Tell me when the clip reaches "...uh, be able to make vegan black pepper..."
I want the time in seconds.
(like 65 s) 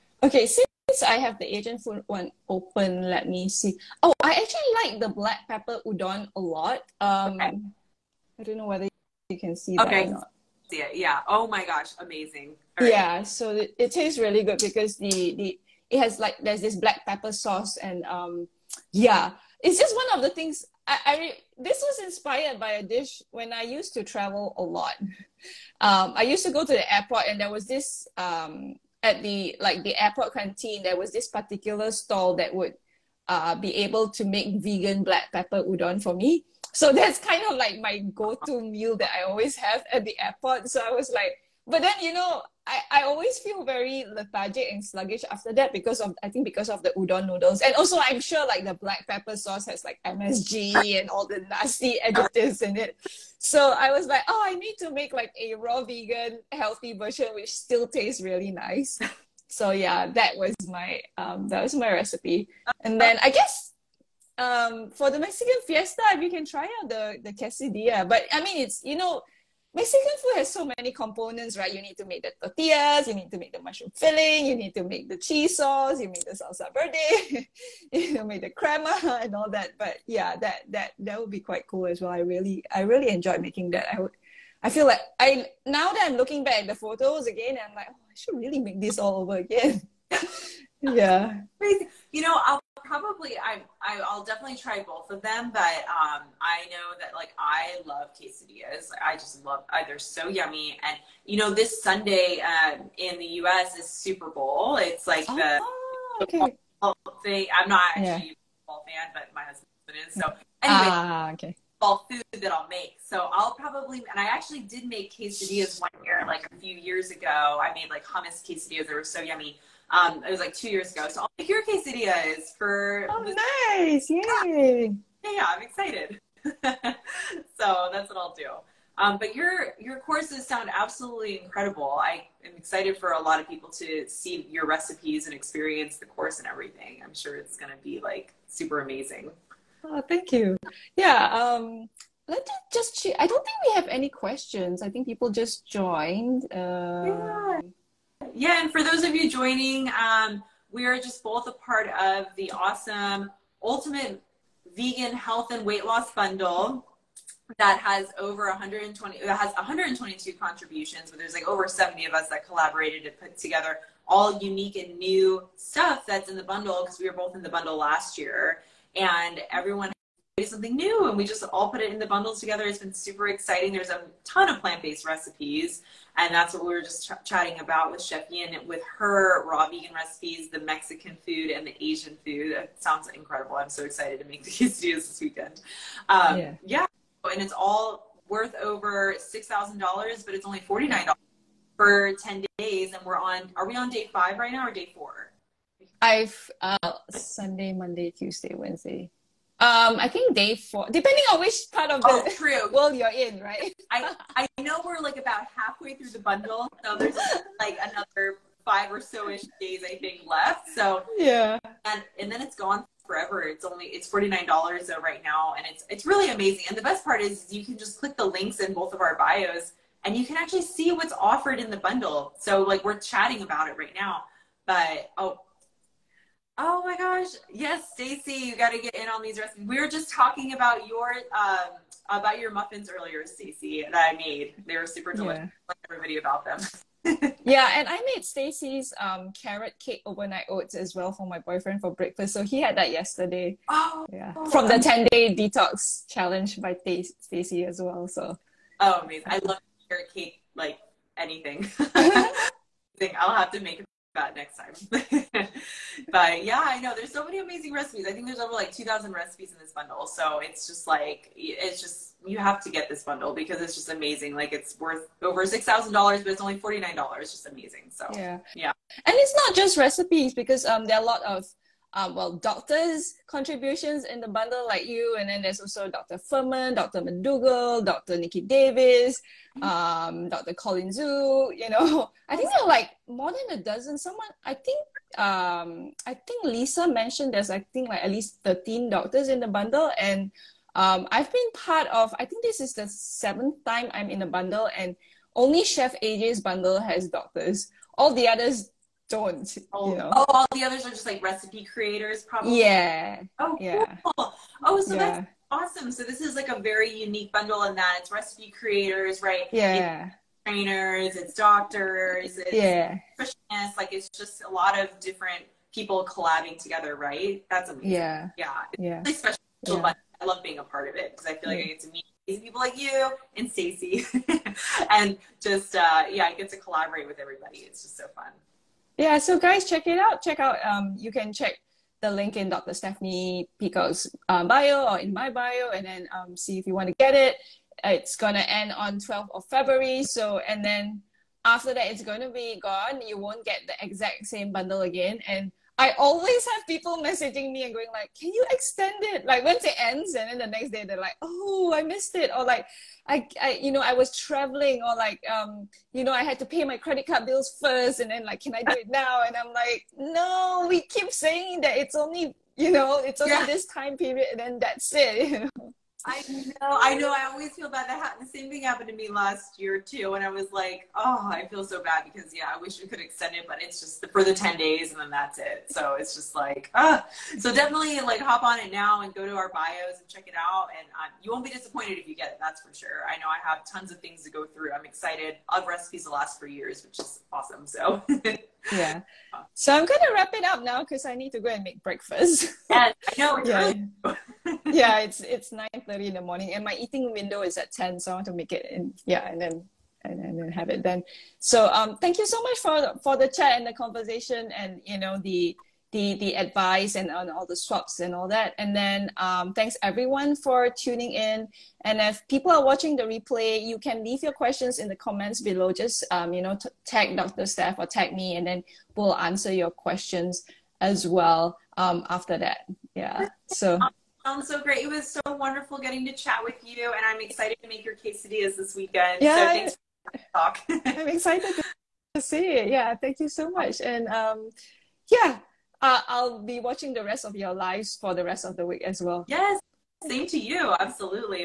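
33 s.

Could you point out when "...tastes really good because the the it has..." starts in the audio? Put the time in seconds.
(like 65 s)
13 s.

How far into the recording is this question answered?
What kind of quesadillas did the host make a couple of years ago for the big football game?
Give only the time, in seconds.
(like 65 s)
118 s.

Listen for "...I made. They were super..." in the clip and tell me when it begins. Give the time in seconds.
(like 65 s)
234 s.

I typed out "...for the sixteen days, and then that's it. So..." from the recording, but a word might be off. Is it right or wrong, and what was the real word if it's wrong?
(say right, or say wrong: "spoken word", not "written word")
wrong: "ten", not "sixteen".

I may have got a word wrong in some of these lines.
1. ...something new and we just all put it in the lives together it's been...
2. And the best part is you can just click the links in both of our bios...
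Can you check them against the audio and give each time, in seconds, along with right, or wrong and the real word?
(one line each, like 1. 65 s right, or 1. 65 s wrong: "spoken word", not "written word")
1. 170 s wrong: "bundles", not "lives"
2. 216 s right.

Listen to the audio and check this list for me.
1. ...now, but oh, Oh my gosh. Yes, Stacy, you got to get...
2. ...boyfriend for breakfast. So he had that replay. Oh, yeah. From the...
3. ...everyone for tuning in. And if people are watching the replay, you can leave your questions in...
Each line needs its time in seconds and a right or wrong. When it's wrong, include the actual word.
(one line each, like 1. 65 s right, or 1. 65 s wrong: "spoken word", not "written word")
1. 223 s right
2. 241 s wrong: "yesterday", not "replay"
3. 409 s right.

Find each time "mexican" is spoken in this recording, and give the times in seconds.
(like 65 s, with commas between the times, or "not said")
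65 s, 69 s, 180 s.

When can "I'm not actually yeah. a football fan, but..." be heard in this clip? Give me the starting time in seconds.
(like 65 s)
107 s.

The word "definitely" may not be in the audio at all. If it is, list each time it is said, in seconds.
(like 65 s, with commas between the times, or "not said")
94 s, 377 s.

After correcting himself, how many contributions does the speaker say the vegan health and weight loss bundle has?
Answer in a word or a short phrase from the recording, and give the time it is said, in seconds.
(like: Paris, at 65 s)
122, at 159 s.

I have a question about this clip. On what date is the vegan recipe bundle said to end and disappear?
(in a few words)
12th of February.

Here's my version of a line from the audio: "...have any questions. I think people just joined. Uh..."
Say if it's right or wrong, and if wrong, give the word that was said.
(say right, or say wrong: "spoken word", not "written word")
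right.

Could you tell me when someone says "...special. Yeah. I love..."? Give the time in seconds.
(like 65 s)
319 s.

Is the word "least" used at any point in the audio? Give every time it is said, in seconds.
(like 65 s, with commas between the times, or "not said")
288 s.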